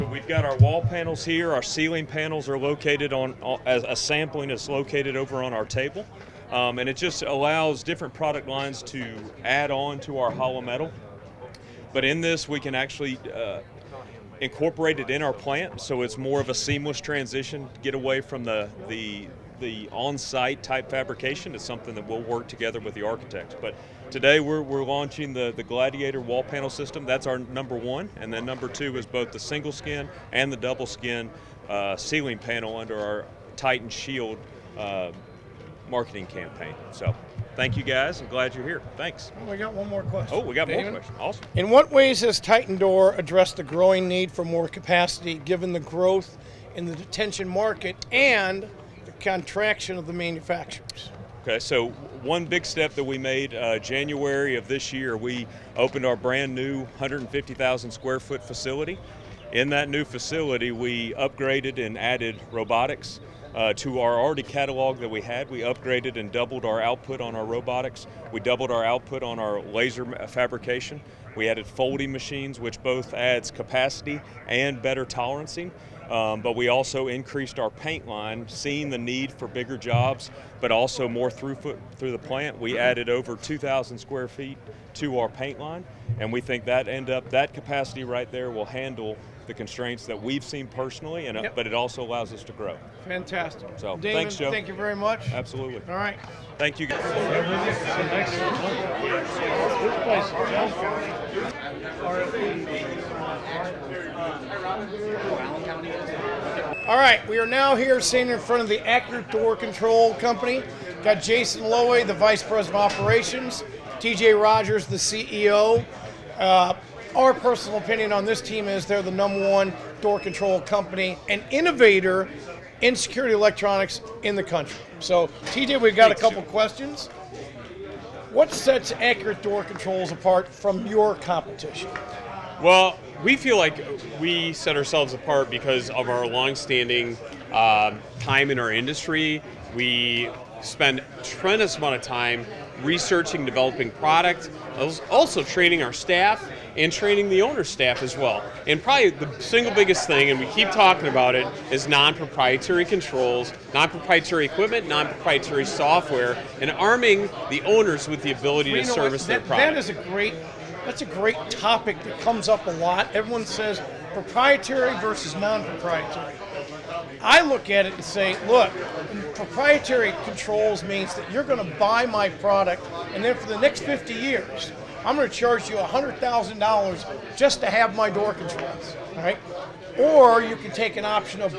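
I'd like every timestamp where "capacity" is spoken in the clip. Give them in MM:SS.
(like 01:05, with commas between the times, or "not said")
00:44, 01:13, 01:27.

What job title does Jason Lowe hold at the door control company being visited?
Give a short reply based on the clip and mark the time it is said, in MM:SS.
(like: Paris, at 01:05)
Vice President of Operations, at 01:52.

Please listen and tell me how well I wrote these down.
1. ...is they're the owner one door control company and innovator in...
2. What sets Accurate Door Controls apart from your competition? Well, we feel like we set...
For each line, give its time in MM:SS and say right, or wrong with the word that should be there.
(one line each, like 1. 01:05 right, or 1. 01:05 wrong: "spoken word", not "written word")
1. 01:58 wrong: "number", not "owner"
2. 02:08 right.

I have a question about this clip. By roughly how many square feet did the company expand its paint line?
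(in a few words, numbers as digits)
over 2,000.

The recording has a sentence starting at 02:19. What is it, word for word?
We spend tremendous amount of time researching, developing product, also training our staff and training the owner staff as well.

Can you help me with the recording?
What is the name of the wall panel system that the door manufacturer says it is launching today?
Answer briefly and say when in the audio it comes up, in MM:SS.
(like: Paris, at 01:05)
Gladiator, at 00:25.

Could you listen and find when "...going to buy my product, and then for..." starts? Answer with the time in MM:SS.
02:51.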